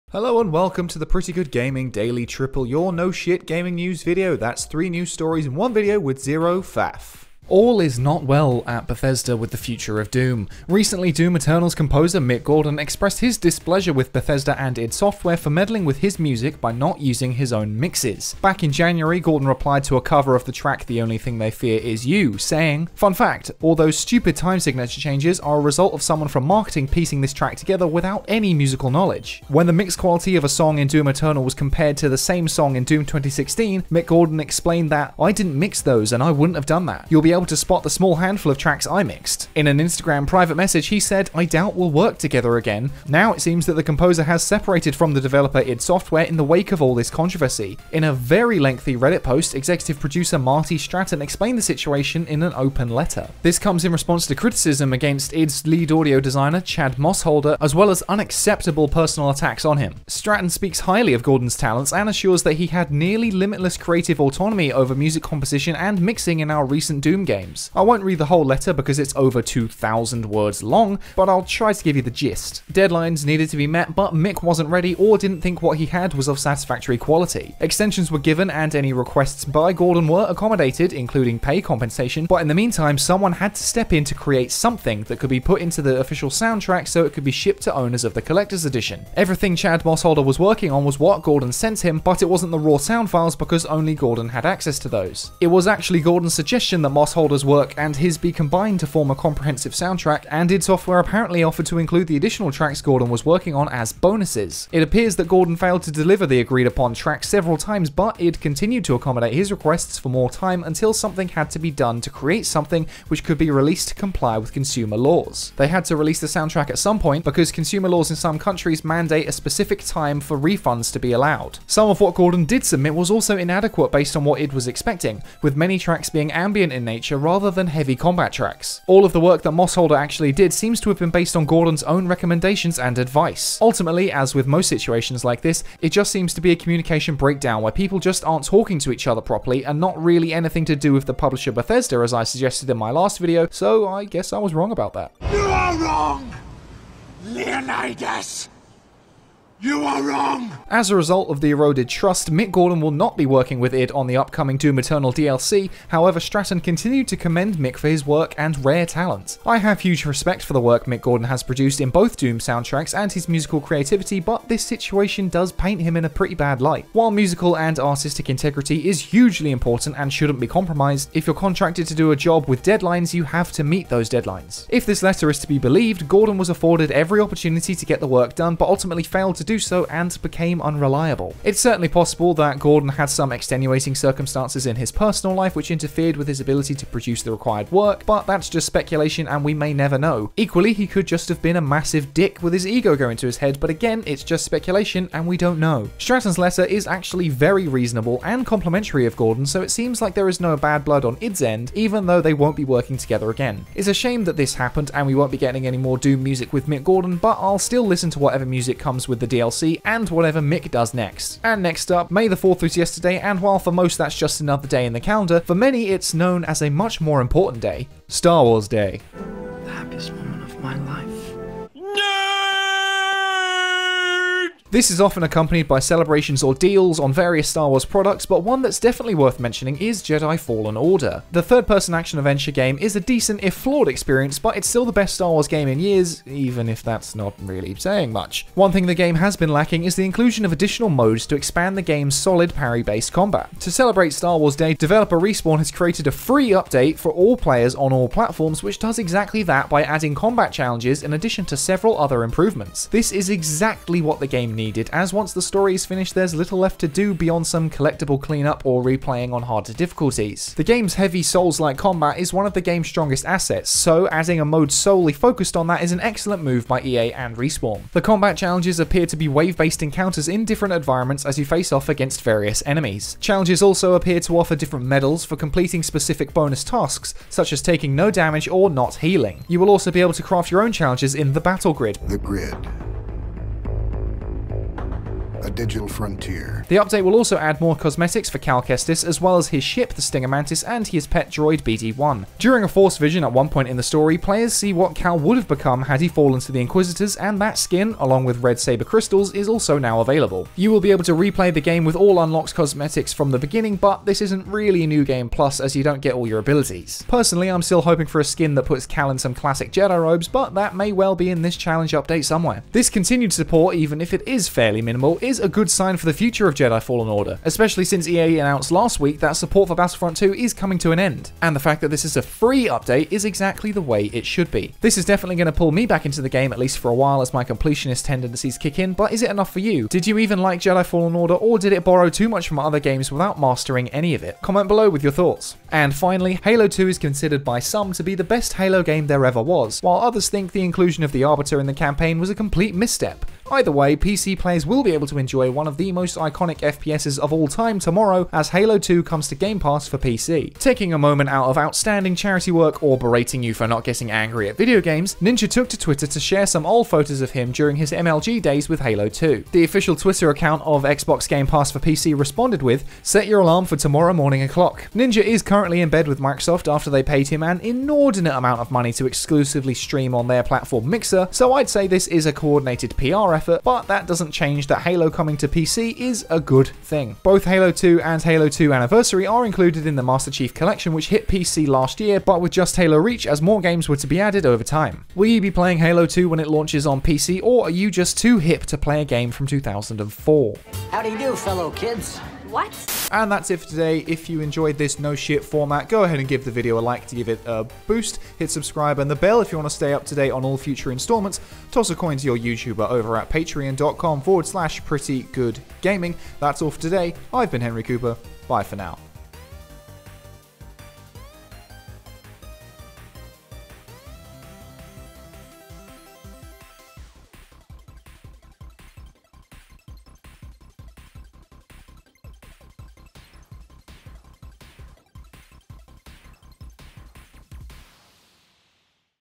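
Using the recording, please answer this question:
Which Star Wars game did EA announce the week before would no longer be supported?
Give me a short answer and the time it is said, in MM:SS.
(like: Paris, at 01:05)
Battlefront 2, at 05:19.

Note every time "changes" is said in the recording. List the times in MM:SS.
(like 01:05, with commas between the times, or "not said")
00:25, 06:14.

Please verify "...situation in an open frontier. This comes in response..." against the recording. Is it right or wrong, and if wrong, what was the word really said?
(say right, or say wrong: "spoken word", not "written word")
wrong: "letter", not "frontier".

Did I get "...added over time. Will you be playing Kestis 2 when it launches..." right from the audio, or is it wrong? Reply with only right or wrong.
wrong.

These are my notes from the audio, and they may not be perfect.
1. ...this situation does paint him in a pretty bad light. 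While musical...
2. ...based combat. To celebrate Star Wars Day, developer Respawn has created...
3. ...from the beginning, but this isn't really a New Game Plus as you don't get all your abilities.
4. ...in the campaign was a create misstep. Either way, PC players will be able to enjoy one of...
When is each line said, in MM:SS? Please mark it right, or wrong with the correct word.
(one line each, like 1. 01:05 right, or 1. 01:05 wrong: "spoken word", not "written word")
1. 02:44 right
2. 04:02 right
3. 05:03 right
4. 05:41 wrong: "complete", not "create".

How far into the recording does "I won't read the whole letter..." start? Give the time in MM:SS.
01:07.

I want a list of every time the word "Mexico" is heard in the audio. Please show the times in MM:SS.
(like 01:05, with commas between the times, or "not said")
not said.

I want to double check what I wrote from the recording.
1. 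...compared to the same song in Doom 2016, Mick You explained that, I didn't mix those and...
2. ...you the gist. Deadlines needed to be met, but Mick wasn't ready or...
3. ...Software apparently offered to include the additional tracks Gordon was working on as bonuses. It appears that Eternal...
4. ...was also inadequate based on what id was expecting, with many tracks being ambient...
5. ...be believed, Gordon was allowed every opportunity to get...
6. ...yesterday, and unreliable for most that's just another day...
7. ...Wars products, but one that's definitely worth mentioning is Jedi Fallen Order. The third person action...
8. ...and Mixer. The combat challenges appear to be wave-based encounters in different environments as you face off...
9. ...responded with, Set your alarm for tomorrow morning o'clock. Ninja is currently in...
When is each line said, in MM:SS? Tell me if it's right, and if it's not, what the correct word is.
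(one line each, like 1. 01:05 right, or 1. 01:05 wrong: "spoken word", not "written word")
1. 00:31 wrong: "Gordon", not "You"
2. 01:11 right
3. 01:40 wrong: "Gordon", not "Eternal"
4. 02:02 right
5. 02:55 wrong: "afforded", not "allowed"
6. 03:32 wrong: "while", not "unreliable"
7. 03:47 right
8. 04:27 wrong: "Respawn", not "Mixer"
9. 06:02 right.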